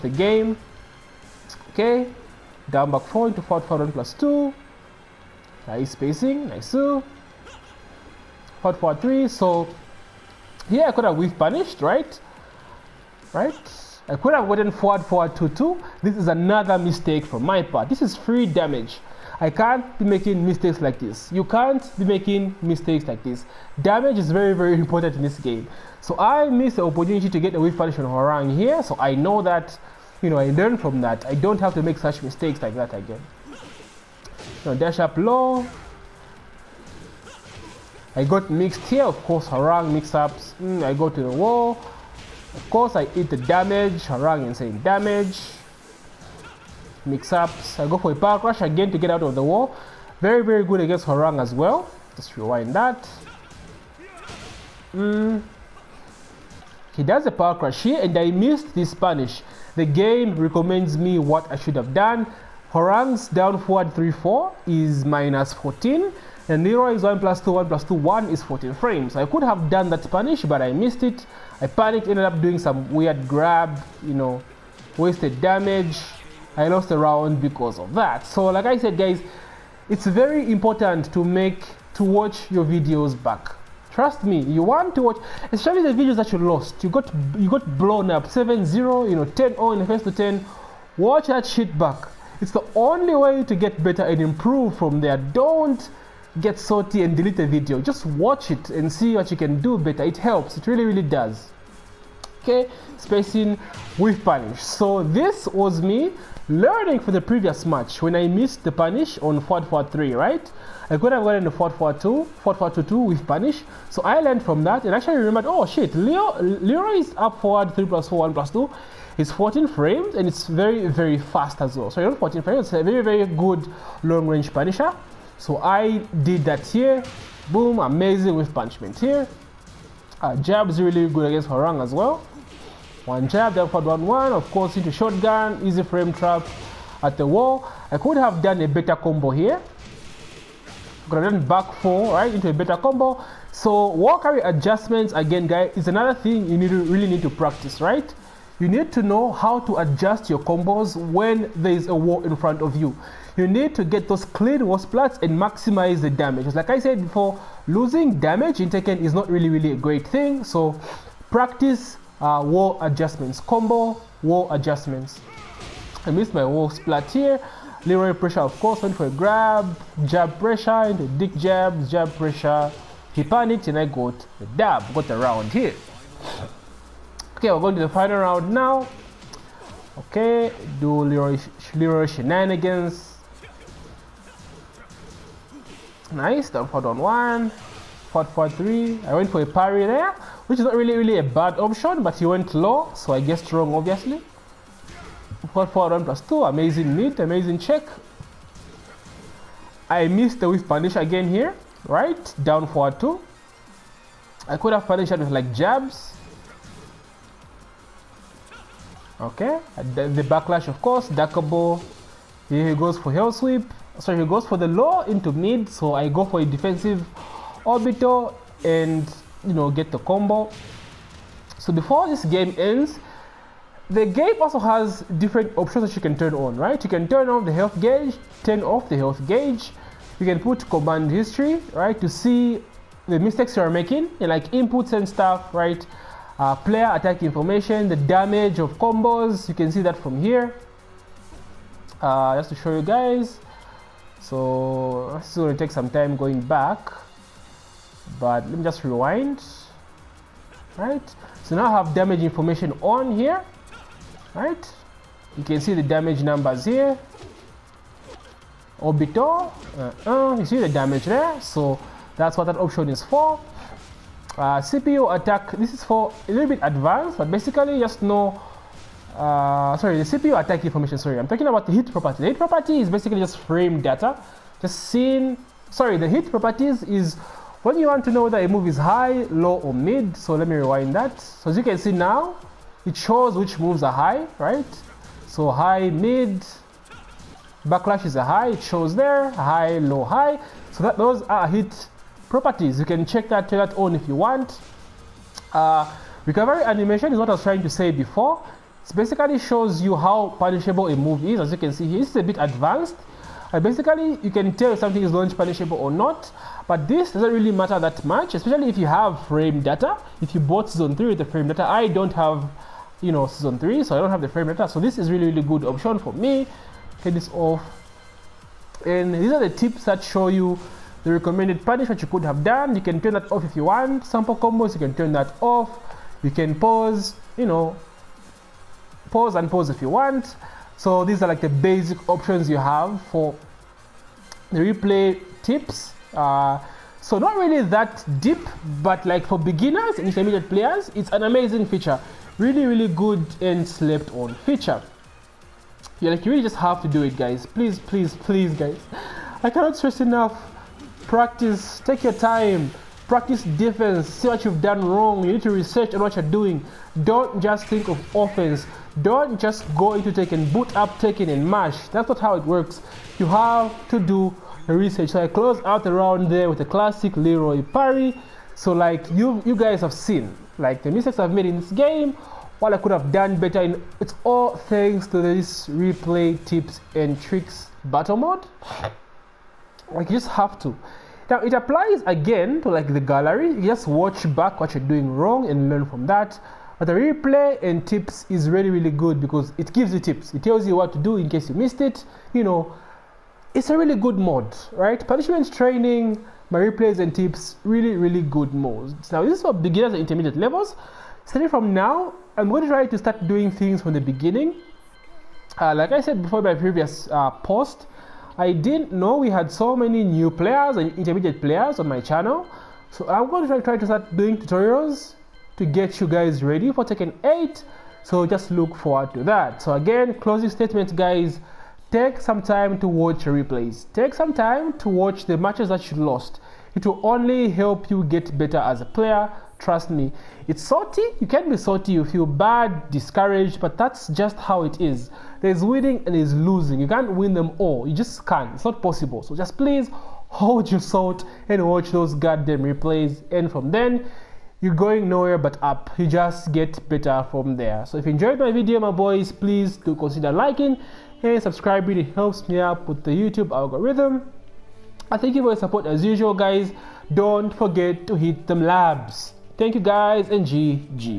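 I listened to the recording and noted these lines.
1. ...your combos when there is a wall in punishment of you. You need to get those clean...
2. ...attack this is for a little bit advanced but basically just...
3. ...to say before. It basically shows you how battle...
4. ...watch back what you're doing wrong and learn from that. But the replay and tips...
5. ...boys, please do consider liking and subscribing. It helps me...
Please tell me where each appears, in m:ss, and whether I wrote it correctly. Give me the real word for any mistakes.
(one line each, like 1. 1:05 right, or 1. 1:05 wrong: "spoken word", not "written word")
1. 2:30 wrong: "front", not "punishment"
2. 4:25 right
3. 4:57 wrong: "punishable", not "battle"
4. 6:23 right
5. 7:28 right.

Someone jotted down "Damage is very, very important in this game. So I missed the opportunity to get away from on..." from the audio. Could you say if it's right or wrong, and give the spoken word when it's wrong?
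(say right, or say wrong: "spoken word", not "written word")
right.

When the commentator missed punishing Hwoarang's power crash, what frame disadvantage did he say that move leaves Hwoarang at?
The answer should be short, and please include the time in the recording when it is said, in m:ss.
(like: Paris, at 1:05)
-14, at 1:05.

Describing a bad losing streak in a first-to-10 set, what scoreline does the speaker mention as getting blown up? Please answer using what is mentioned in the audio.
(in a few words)
10-0.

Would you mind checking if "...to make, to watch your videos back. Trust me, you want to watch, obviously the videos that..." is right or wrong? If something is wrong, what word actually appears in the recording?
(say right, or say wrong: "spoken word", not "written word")
wrong: "especially", not "obviously".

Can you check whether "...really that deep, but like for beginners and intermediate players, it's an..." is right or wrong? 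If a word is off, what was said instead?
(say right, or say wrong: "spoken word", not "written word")
right.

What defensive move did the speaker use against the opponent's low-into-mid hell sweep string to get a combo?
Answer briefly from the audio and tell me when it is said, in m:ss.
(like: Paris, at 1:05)
Defensive orbital, at 3:36.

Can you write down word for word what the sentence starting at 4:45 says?
So high, mid, backlash is a high, it shows there, high, low, high.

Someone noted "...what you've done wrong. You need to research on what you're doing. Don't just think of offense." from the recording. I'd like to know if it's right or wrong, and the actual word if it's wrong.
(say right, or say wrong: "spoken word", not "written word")
right.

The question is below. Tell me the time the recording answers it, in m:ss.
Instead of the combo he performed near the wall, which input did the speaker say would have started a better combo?
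2:21.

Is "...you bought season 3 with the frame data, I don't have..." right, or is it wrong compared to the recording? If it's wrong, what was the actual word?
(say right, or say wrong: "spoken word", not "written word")
right.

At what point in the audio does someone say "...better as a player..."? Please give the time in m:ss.
7:08.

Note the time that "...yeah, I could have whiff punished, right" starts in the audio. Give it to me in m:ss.
0:10.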